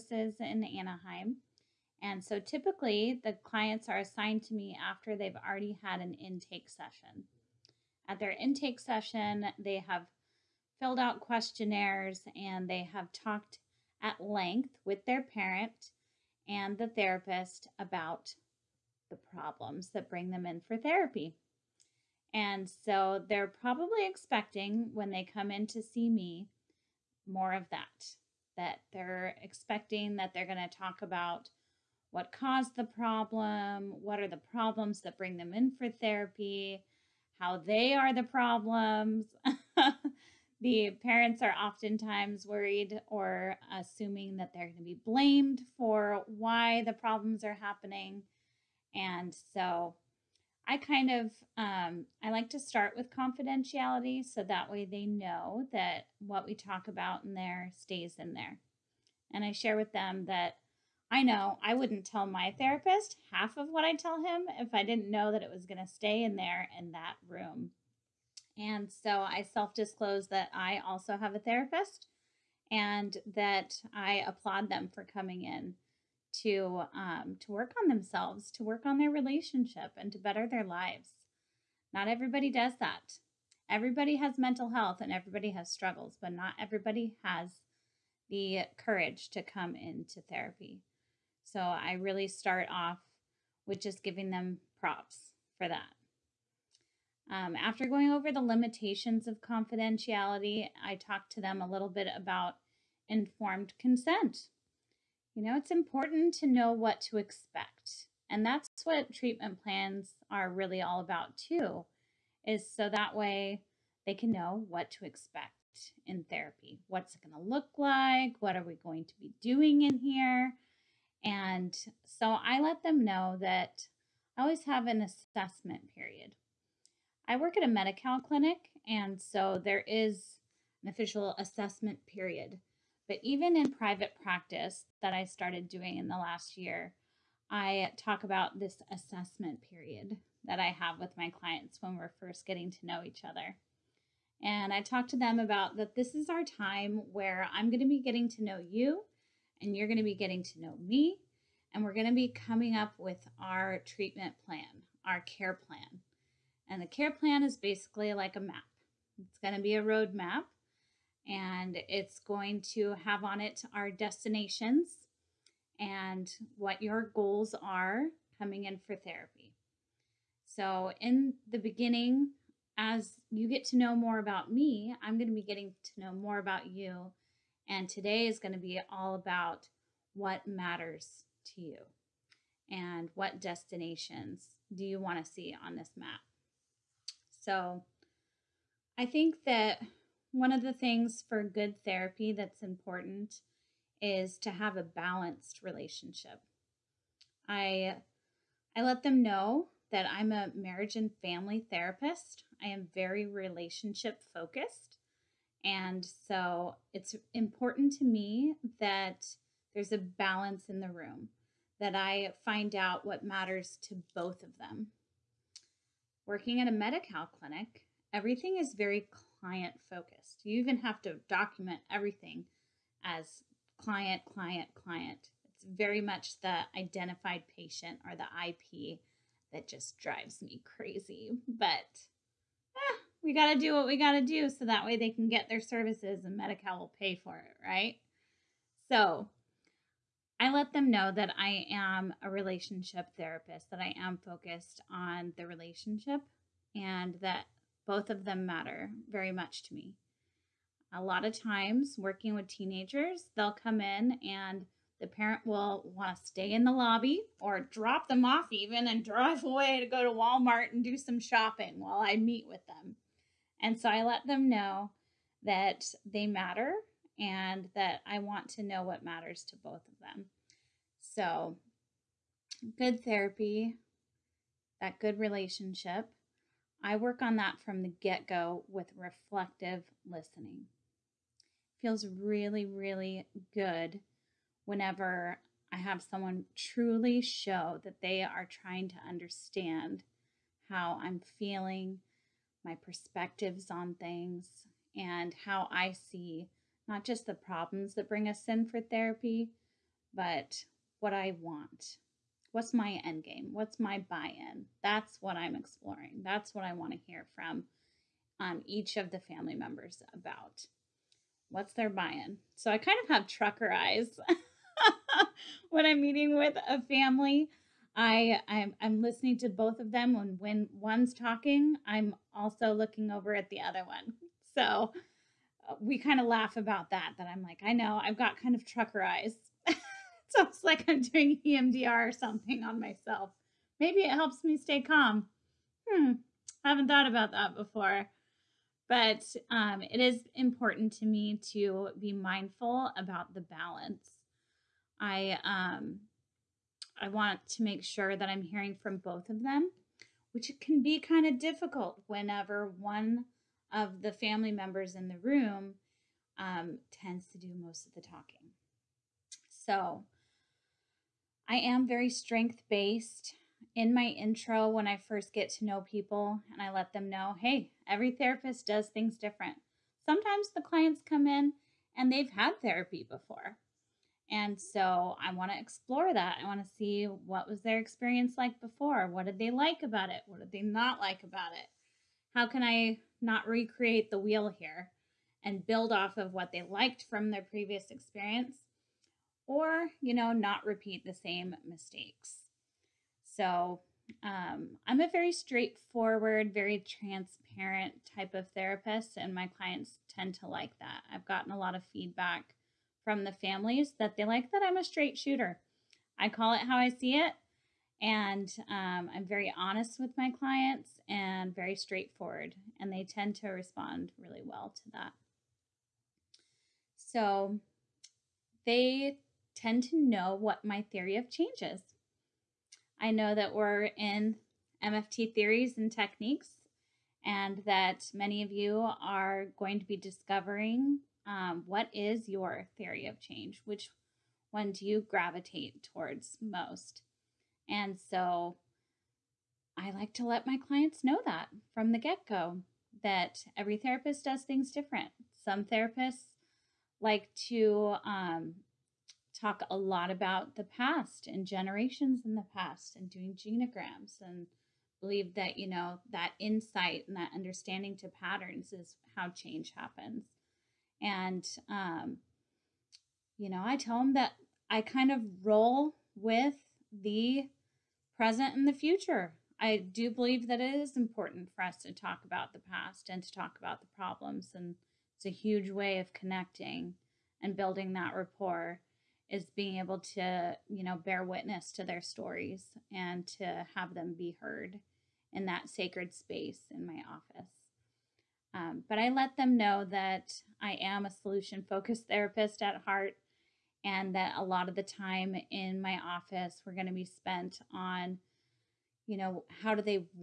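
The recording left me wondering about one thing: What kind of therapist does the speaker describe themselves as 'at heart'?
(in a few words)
Solution focused.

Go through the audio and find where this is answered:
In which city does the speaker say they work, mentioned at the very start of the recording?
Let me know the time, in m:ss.
0:00.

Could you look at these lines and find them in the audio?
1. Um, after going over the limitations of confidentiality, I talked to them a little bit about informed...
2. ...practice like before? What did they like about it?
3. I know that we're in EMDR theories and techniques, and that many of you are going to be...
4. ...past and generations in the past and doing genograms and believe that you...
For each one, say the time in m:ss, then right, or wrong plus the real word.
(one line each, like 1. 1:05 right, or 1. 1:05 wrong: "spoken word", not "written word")
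1. 1:37 right
2. 6:17 wrong: "experience", not "practice"
3. 7:02 wrong: "MFT", not "EMDR"
4. 7:30 right.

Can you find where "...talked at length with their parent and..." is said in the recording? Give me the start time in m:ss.
0:13.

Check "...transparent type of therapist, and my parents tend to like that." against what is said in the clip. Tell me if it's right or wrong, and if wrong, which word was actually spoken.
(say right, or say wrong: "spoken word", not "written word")
wrong: "clients", not "parents".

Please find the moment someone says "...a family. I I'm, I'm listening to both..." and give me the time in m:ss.
5:16.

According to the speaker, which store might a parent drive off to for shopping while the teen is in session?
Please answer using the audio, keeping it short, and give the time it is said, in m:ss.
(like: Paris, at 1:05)
Walmart, at 4:20.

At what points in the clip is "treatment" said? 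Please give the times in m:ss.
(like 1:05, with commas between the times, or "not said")
1:49, 2:33.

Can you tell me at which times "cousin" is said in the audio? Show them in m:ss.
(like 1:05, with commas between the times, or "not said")
not said.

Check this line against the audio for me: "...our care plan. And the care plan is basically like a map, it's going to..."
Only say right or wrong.
right.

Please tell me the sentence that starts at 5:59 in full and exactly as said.
So I am very strength based.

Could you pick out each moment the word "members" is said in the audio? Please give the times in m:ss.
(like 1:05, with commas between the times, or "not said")
5:09, 5:54.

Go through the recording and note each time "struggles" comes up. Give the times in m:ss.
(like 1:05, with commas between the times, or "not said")
1:25.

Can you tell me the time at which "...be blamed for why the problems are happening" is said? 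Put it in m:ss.
0:44.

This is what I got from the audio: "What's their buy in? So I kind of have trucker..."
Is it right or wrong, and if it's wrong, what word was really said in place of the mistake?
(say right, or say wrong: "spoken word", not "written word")
right.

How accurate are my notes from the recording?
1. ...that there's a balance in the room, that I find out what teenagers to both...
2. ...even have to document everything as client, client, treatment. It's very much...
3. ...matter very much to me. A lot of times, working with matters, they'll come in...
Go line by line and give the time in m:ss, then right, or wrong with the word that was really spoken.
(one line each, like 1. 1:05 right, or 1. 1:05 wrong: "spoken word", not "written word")
1. 3:28 wrong: "matters", not "teenagers"
2. 3:40 wrong: "client", not "treatment"
3. 4:08 wrong: "teenagers", not "matters".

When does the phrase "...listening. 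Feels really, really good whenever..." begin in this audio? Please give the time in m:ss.
4:40.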